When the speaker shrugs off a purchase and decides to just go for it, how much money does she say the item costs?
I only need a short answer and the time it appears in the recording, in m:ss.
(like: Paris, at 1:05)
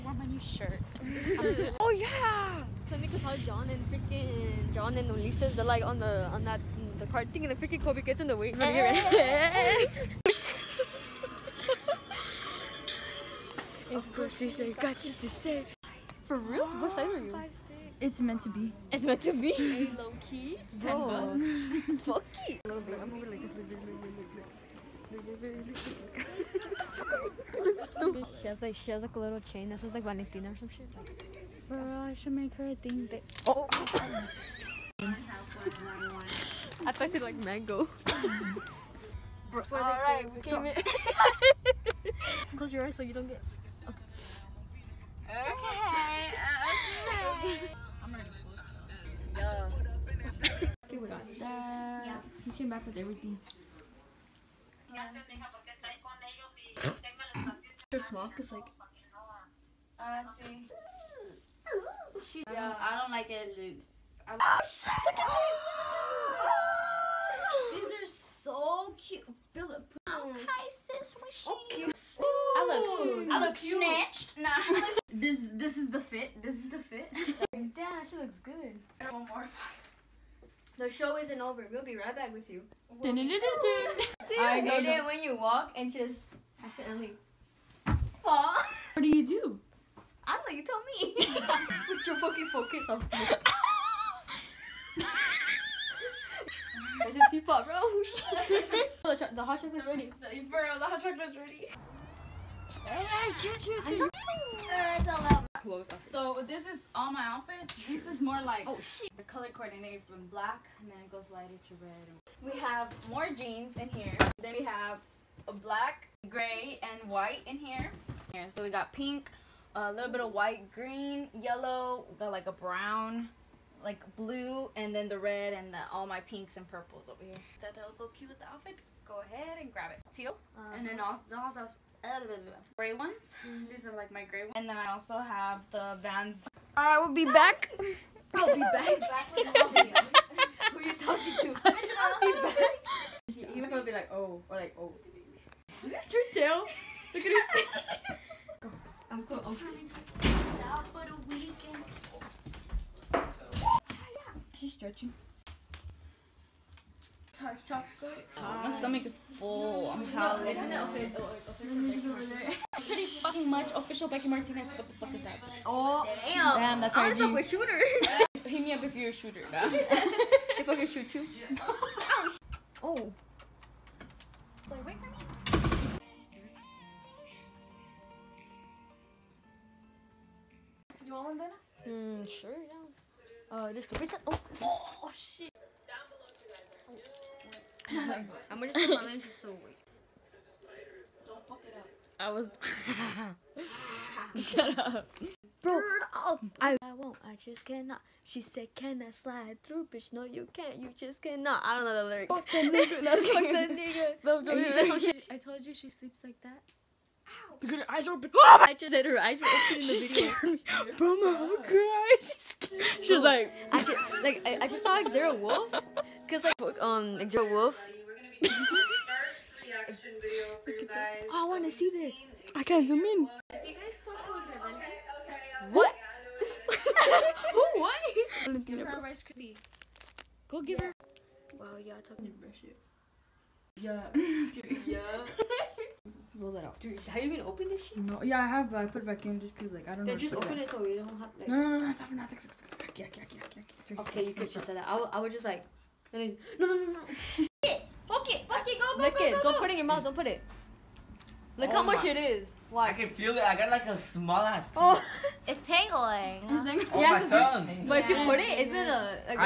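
$10, at 0:20.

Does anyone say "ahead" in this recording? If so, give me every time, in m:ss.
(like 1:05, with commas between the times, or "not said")
2:09.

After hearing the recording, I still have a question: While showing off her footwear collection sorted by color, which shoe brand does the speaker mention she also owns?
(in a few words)
Vans.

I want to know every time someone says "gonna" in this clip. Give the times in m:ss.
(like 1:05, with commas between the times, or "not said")
2:23, 3:08.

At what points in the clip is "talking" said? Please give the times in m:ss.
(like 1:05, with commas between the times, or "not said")
2:21, 3:52.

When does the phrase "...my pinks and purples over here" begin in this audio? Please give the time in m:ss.
2:06.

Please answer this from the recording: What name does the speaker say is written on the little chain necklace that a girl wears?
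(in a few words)
Valentina.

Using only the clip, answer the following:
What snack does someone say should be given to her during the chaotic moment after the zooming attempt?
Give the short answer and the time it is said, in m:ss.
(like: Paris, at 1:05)
Rice Krispie, at 3:49.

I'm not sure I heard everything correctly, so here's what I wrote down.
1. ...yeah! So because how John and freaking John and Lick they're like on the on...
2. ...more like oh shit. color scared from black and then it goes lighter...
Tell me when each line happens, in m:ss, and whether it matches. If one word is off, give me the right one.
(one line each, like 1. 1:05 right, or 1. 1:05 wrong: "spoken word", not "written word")
1. 0:01 wrong: "Ulises", not "Lick"
2. 1:48 wrong: "coordinated", not "scared".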